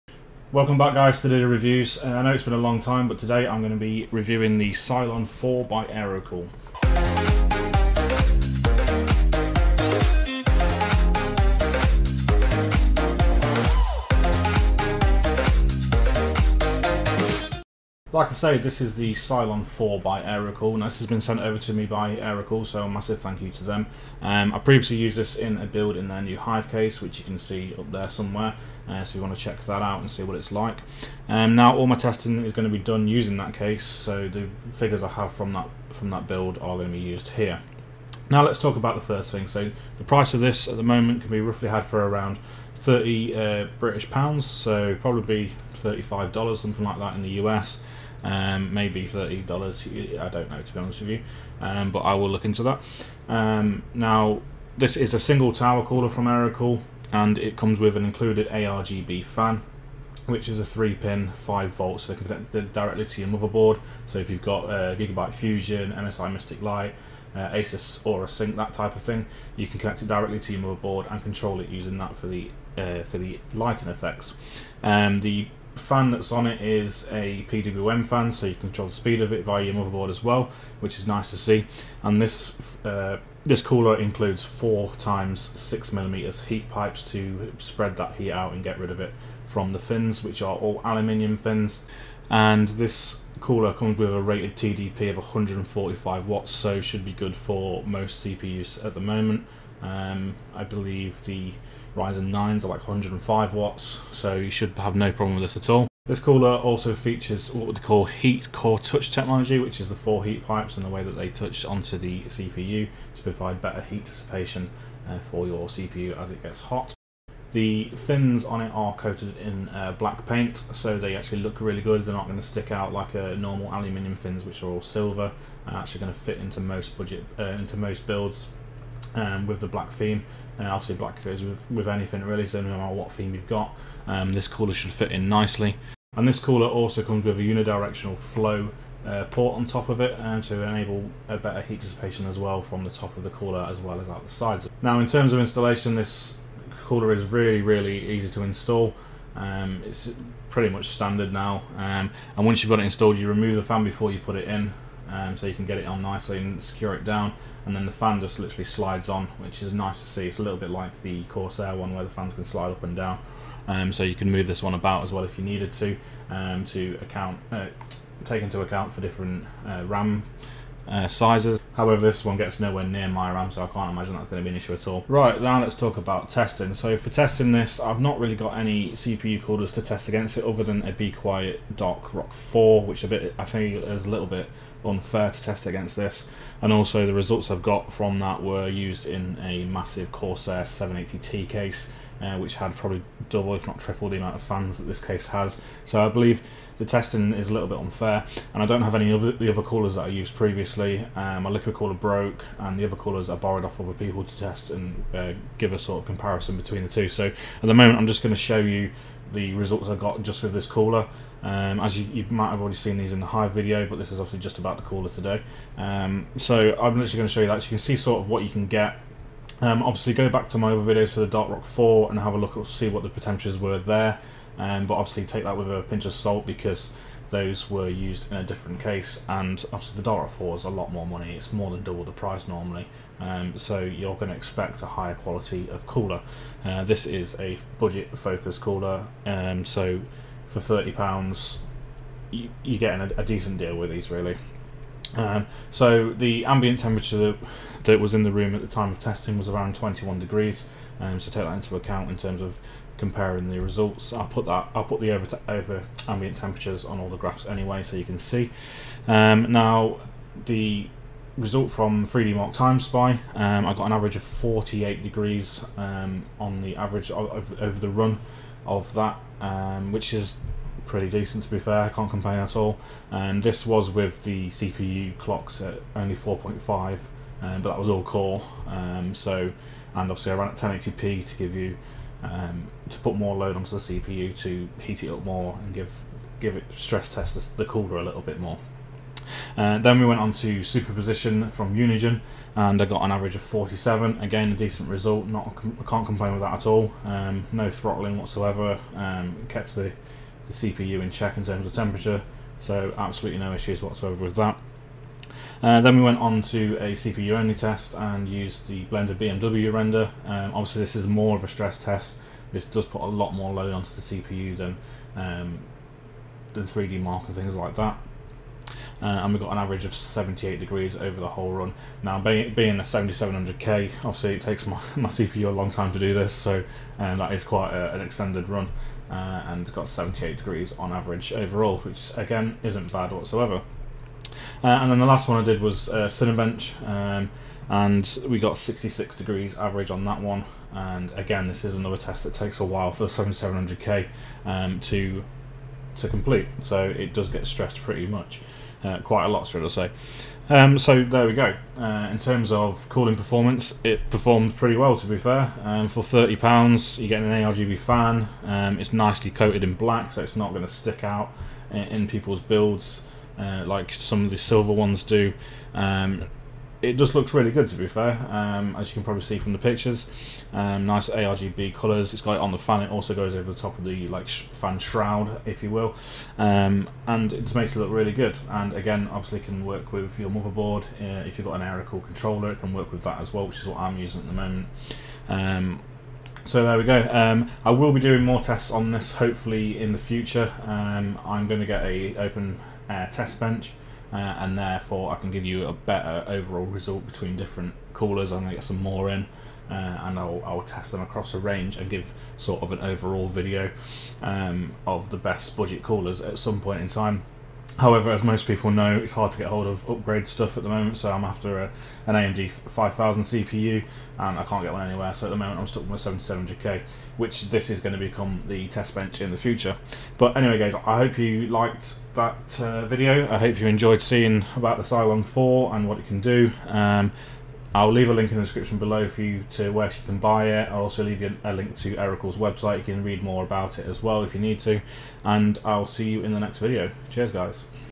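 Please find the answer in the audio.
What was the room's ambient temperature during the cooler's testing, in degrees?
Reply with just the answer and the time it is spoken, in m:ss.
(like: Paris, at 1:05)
21, at 4:09.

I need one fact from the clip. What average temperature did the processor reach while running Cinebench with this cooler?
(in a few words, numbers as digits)
66 degrees.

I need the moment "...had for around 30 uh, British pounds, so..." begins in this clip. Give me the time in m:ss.
0:41.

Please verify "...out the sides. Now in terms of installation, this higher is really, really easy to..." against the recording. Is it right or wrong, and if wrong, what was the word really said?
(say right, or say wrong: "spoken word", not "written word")
wrong: "cooler", not "higher".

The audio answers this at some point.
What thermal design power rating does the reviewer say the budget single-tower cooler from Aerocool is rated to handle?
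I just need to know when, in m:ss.
1:35.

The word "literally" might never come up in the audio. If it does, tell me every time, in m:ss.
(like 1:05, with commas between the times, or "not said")
2:38, 3:36.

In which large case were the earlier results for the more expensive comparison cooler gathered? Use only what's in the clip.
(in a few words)
Corsair 780T.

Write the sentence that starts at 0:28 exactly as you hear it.
Uh, so you want to check that out and see what it's like.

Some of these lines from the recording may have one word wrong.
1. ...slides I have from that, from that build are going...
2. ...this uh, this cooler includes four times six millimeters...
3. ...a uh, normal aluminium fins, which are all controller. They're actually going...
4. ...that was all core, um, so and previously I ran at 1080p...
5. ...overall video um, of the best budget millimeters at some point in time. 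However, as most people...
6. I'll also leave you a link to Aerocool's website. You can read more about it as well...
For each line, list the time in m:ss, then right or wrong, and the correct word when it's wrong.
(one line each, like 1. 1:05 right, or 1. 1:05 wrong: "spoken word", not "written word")
1. 0:34 wrong: "figures", not "slides"
2. 1:22 right
3. 2:03 wrong: "silver", not "controller"
4. 4:37 wrong: "obviously", not "previously"
5. 6:42 wrong: "coolers", not "millimeters"
6. 7:10 right.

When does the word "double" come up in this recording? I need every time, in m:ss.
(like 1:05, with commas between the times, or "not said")
3:13, 3:51.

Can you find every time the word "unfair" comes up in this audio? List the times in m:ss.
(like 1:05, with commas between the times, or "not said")
3:04, 3:17.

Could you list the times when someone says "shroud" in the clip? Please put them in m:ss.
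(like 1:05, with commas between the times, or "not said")
6:14.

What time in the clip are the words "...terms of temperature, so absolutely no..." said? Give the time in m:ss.
5:01.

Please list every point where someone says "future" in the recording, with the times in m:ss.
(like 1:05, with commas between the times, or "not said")
6:29, 6:59.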